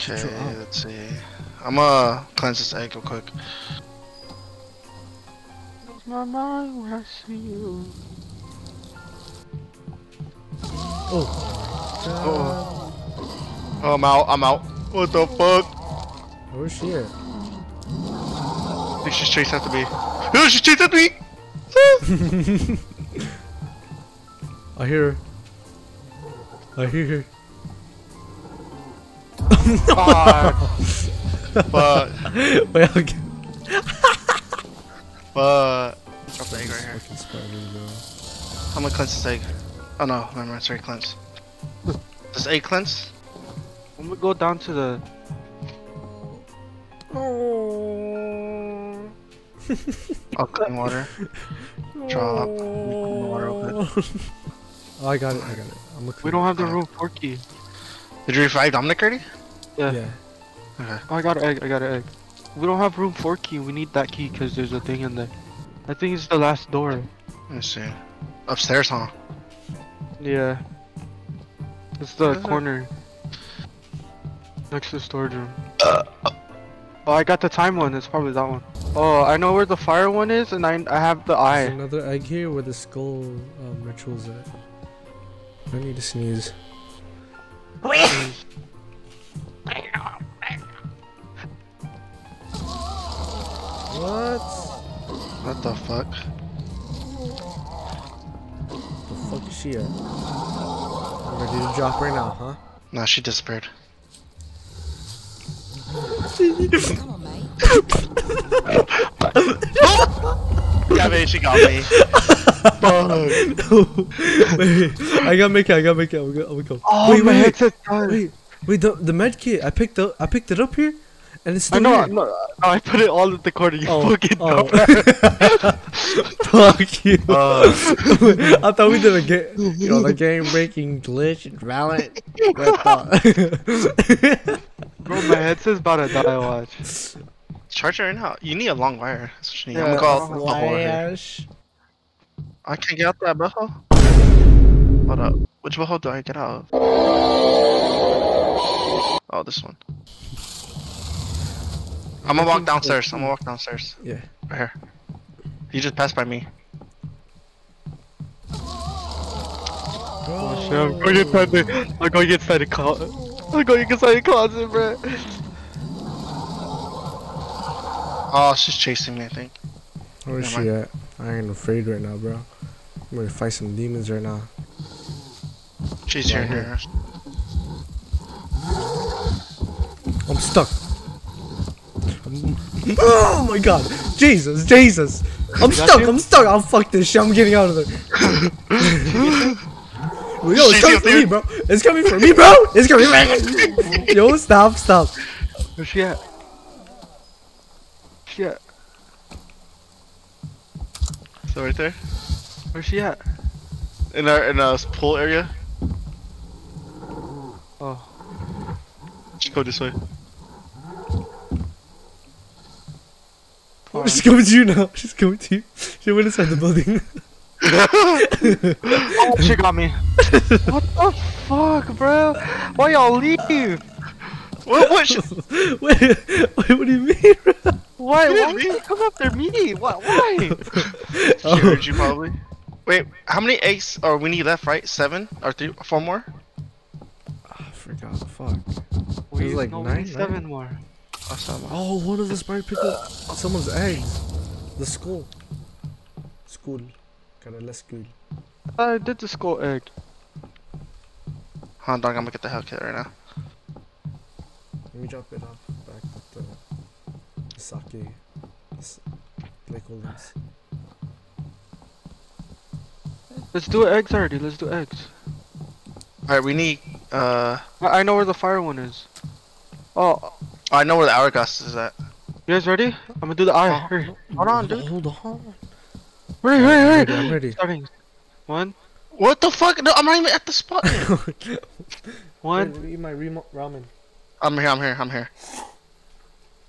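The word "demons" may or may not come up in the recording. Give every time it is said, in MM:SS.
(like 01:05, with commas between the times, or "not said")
02:53.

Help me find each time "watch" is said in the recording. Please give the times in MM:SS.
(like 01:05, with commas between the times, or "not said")
02:16.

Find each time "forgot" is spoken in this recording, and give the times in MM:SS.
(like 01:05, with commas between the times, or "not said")
03:57.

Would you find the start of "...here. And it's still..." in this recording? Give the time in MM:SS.
02:00.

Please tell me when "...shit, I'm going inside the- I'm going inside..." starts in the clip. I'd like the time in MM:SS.
02:40.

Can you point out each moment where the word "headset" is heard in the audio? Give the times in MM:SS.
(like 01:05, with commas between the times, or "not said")
01:57, 02:15.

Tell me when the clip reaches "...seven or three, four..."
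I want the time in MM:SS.
03:54.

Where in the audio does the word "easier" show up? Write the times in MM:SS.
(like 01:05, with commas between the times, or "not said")
not said.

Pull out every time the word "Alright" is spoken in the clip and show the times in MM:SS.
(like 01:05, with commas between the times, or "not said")
04:26.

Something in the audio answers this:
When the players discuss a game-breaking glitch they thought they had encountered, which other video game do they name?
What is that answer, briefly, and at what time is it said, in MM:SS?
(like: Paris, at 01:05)
Valorant, at 02:11.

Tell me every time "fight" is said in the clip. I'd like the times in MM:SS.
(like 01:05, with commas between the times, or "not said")
02:53.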